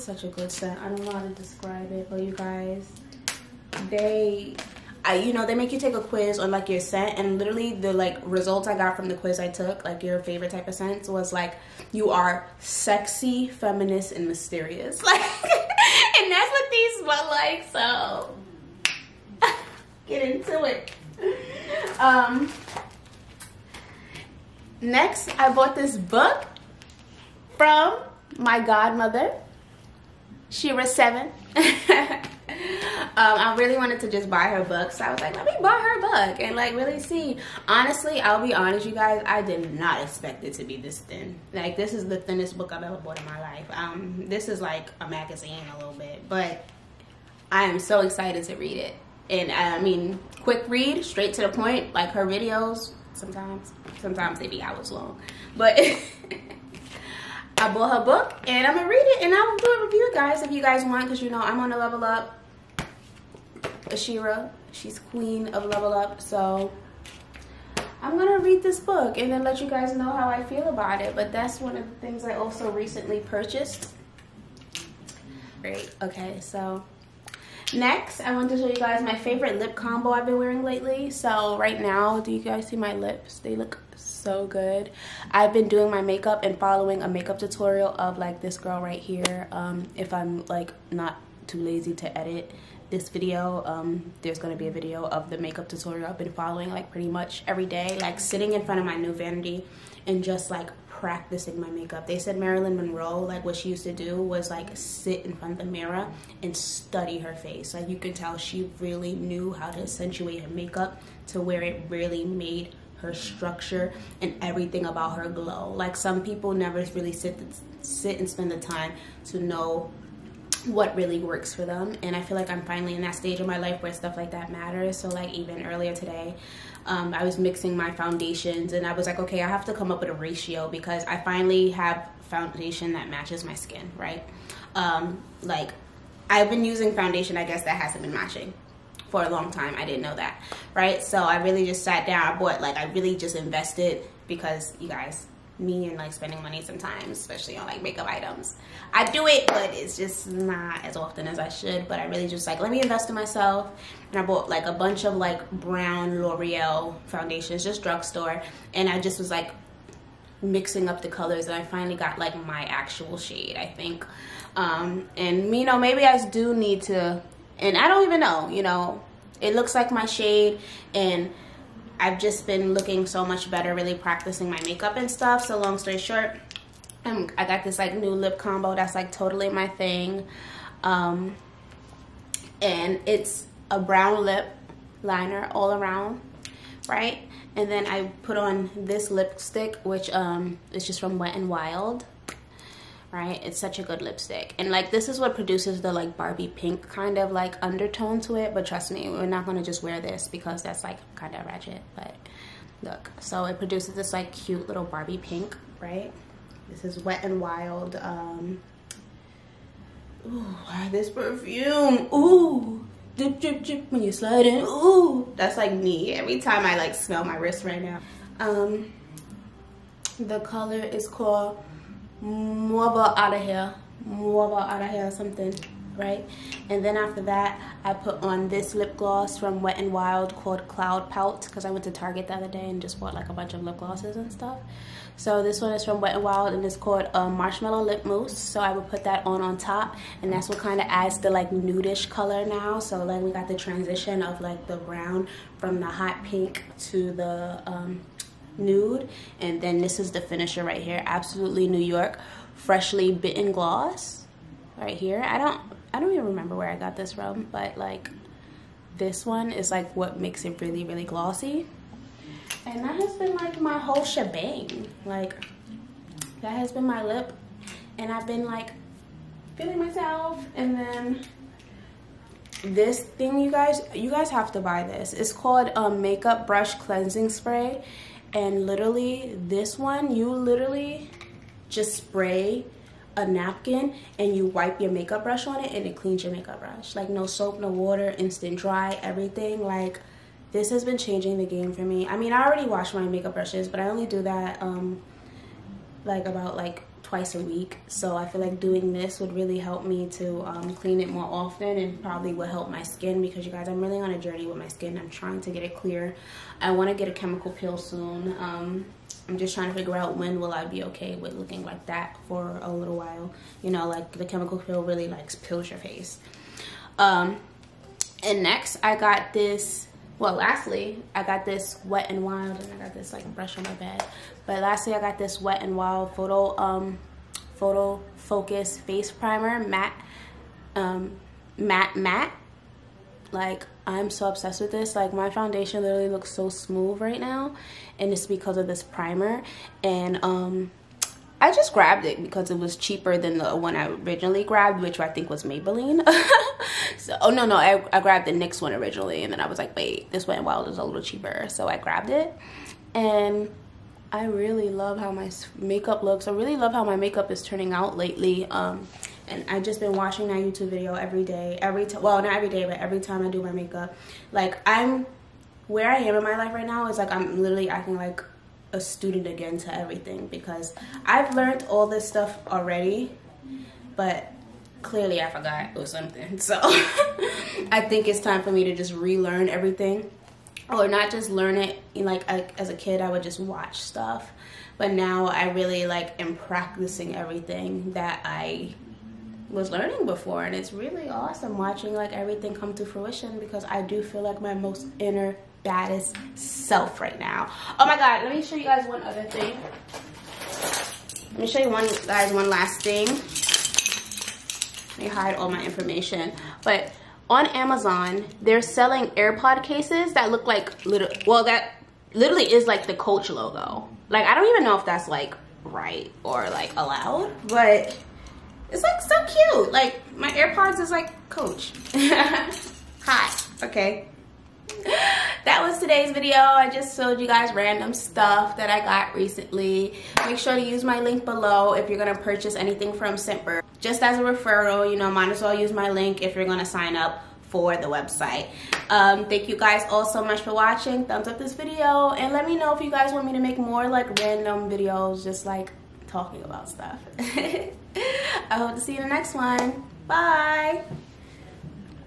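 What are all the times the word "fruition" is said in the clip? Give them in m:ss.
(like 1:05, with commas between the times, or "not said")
6:32.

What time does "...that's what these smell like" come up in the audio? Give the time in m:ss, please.
0:16.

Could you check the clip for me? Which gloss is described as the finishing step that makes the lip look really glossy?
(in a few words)
Freshly Bitten.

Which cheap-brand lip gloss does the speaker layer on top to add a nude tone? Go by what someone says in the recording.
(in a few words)
Marshmallow Lip Mousse.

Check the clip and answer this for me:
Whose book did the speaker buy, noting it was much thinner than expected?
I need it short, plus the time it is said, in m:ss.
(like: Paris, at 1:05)
SheRa Seven, at 0:30.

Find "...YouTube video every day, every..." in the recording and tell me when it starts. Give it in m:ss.
6:00.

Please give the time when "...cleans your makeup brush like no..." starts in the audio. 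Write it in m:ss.
4:45.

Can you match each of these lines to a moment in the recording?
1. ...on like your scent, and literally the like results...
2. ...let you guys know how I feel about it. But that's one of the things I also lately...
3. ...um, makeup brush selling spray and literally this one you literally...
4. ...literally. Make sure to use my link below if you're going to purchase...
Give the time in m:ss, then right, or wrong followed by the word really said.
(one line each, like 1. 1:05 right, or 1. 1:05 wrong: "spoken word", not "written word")
1. 0:06 right
2. 1:09 wrong: "recently", not "lately"
3. 4:35 wrong: "cleansing", not "selling"
4. 7:09 wrong: "recently", not "literally".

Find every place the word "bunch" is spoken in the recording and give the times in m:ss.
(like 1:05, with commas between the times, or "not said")
2:34, 3:53.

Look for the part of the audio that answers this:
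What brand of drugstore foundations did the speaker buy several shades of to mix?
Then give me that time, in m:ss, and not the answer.
2:36.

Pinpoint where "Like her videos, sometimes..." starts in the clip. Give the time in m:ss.
0:51.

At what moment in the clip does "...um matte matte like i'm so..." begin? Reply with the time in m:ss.
5:30.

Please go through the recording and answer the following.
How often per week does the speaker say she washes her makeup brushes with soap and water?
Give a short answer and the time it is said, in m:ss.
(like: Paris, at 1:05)
twice, at 4:57.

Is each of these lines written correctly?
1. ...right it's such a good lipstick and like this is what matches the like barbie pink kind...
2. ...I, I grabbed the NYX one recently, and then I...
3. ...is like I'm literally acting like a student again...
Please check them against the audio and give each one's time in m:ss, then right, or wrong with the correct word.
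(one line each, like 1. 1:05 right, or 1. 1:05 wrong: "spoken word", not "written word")
1. 3:13 wrong: "produces", not "matches"
2. 5:47 wrong: "originally", not "recently"
3. 6:06 right.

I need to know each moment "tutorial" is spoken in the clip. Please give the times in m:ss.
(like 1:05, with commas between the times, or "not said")
1:27, 1:35.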